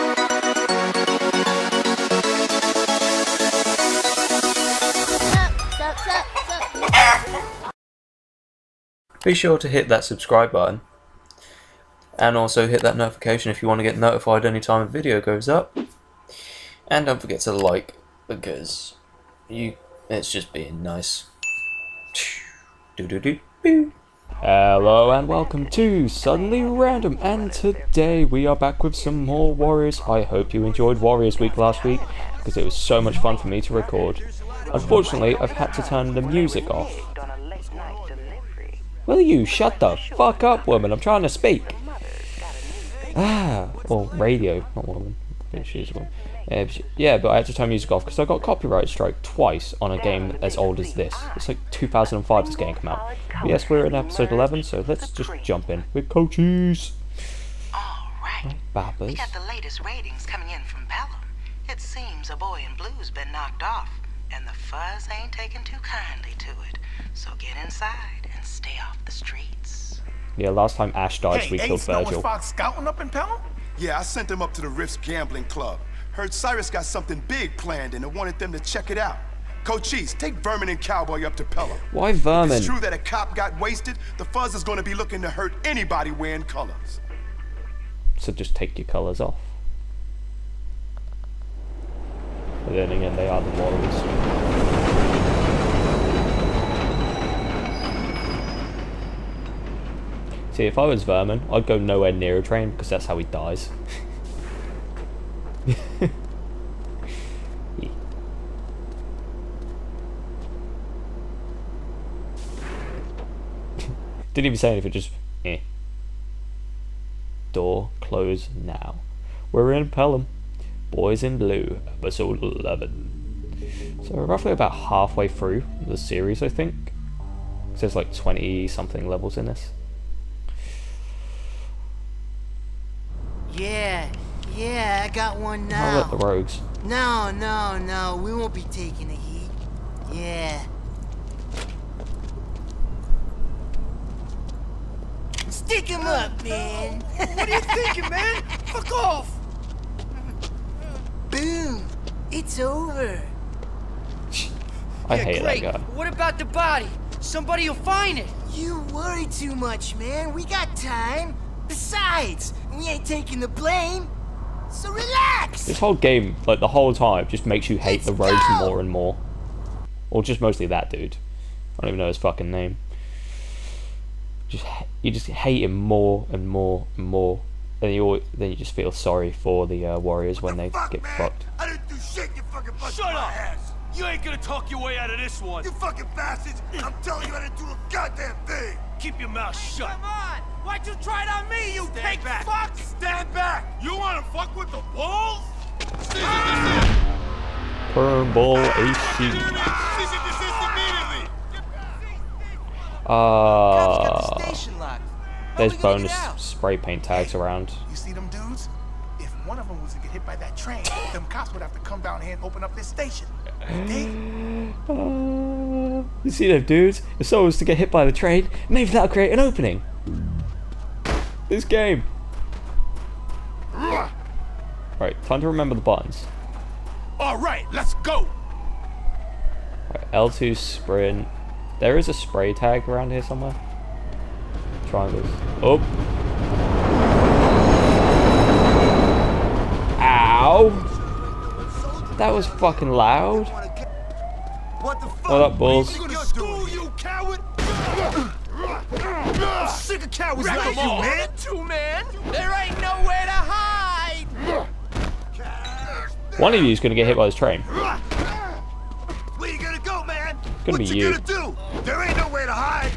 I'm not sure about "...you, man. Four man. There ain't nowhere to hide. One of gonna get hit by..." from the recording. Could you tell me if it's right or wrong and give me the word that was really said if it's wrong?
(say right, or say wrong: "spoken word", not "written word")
wrong: "Two", not "Four".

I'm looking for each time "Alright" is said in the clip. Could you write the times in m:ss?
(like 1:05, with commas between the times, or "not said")
0:57, 3:47.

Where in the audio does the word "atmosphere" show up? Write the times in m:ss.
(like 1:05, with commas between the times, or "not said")
not said.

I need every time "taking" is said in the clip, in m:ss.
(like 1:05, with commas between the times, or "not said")
1:05, 2:18, 2:43.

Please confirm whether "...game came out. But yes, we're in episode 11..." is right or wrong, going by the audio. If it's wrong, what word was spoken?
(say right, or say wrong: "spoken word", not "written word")
right.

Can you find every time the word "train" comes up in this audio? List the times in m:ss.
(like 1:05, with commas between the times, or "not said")
1:42, 3:30, 3:38, 4:17.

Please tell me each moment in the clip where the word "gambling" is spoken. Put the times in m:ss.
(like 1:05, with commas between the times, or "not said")
1:15.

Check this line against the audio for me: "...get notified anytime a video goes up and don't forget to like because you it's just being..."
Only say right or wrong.
right.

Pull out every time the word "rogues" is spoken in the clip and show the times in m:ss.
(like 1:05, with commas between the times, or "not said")
2:16, 2:48.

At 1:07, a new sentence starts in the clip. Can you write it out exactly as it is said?
So get inside and stay off the streets.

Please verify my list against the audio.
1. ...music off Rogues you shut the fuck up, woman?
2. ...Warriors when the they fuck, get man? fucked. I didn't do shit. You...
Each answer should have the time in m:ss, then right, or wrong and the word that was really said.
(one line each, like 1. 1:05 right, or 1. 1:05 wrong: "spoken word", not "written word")
1. 0:36 wrong: "Will", not "Rogues"
2. 2:59 right.